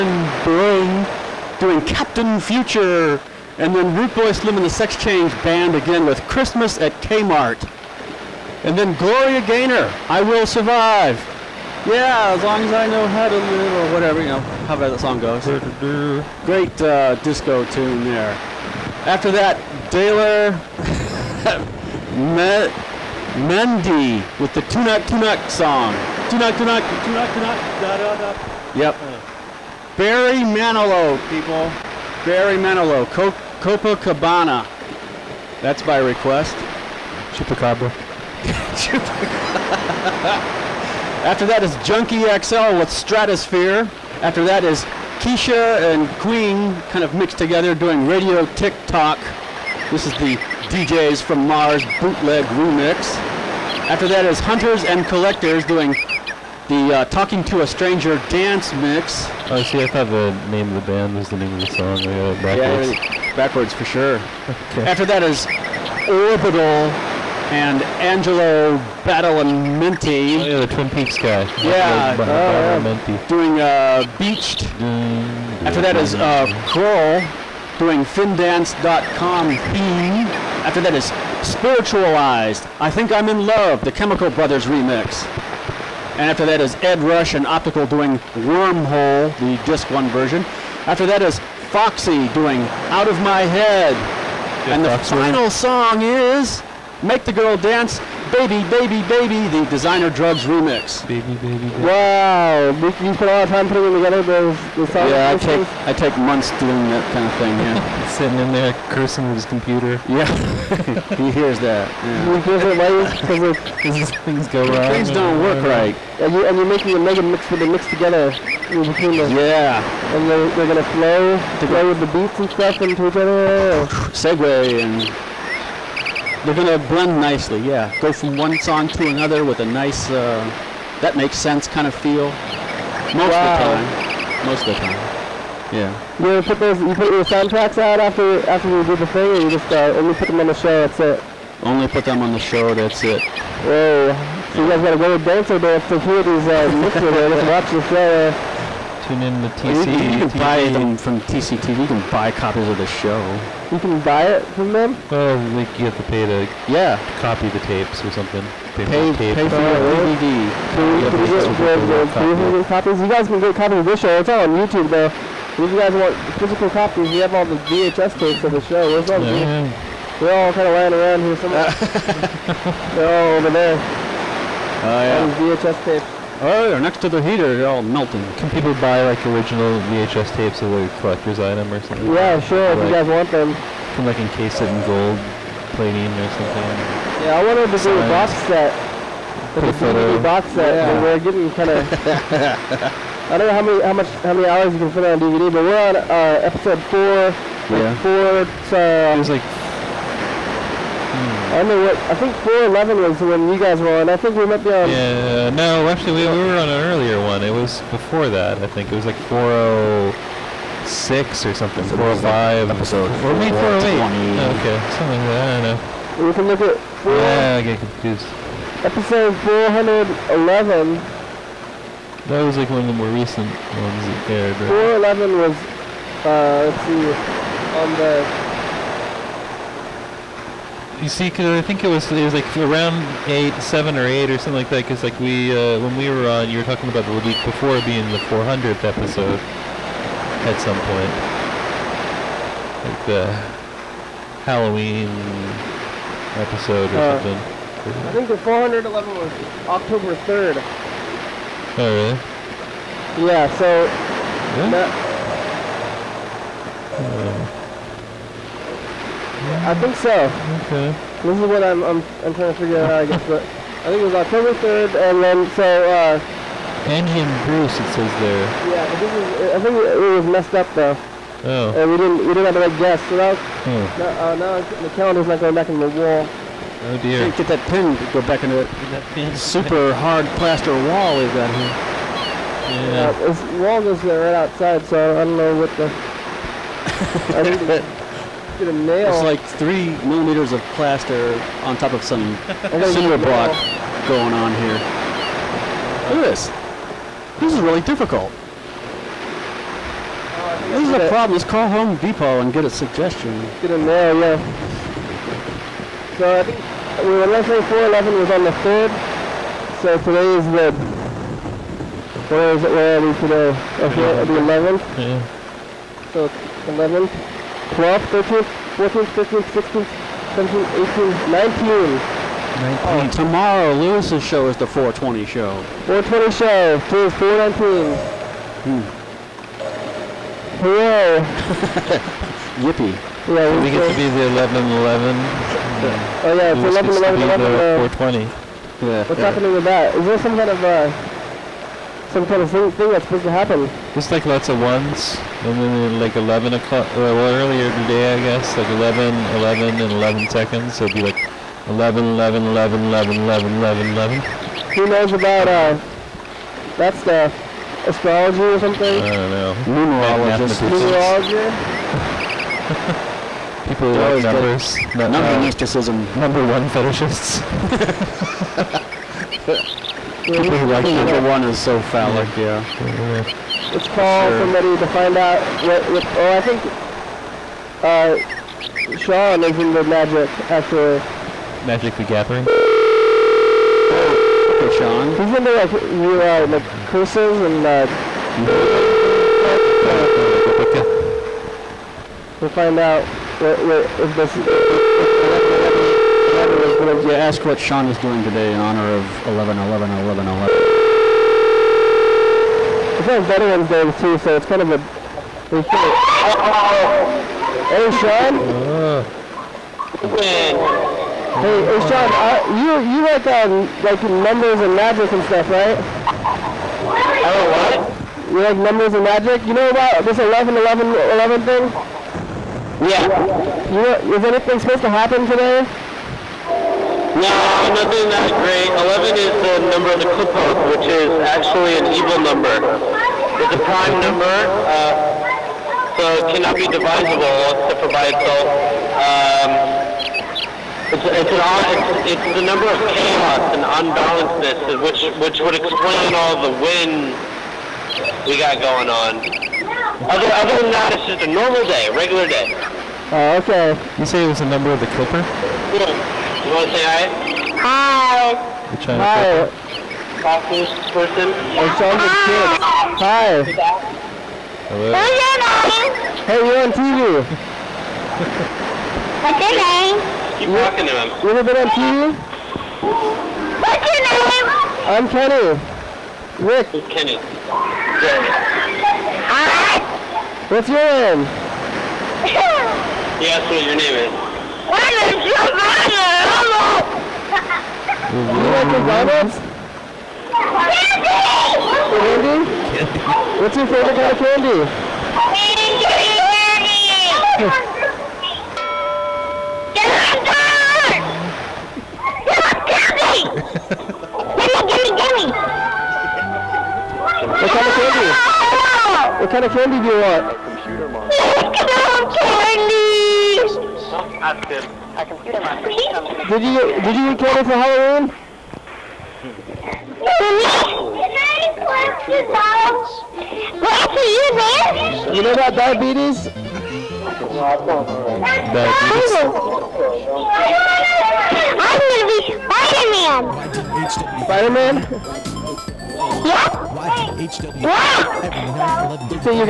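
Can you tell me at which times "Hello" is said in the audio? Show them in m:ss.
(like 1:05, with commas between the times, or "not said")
7:44, 8:06.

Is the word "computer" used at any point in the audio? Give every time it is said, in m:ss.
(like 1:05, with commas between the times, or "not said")
1:49, 8:30.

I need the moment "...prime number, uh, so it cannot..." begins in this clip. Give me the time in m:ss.
7:13.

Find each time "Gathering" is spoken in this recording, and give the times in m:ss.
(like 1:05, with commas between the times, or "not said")
6:22.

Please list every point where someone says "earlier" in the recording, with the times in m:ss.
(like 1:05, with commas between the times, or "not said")
3:26, 5:47.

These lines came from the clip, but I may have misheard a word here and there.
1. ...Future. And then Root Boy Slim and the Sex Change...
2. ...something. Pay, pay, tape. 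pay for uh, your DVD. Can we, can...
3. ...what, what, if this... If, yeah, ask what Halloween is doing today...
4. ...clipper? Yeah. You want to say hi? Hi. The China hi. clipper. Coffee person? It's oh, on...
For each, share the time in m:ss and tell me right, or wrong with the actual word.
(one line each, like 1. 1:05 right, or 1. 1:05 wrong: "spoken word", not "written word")
1. 0:02 right
2. 2:38 right
3. 6:33 wrong: "Sean", not "Halloween"
4. 7:34 right.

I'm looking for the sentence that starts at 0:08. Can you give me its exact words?
And then Gloria Gaynor, I Will Survive.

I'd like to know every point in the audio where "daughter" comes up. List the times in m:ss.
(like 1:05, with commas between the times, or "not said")
not said.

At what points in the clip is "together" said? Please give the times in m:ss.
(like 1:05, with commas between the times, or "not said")
0:47, 1:43, 1:57.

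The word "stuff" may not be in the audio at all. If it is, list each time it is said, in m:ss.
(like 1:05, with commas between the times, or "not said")
2:02, 5:56, 6:55.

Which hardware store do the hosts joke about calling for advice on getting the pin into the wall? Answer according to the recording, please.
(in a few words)
Home Depot.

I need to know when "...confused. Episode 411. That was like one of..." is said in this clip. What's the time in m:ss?
3:37.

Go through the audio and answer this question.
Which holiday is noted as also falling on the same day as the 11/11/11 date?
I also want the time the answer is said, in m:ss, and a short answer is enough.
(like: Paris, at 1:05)
Veterans Day, at 6:43.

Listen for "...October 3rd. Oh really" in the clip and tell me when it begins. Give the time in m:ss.
4:09.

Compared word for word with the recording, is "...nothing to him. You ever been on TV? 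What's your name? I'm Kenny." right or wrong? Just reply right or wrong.
wrong.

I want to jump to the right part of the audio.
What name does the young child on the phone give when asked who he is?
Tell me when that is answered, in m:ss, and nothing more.
8:05.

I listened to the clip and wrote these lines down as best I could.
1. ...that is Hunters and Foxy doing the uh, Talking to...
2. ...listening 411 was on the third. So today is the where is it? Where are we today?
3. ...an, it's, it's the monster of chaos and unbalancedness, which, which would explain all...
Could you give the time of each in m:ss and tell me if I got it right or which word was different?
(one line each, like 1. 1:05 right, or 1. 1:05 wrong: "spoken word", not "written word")
1. 0:54 wrong: "Collectors", not "Foxy"
2. 5:07 right
3. 7:21 wrong: "number", not "monster".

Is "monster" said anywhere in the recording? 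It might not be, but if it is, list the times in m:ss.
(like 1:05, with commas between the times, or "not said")
8:30.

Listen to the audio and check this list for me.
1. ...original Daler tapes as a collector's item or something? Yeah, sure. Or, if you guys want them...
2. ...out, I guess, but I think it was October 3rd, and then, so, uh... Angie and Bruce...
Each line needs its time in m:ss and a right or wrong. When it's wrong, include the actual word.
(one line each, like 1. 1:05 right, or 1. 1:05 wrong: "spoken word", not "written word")
1. 2:59 wrong: "VHS", not "Daler"
2. 4:22 right.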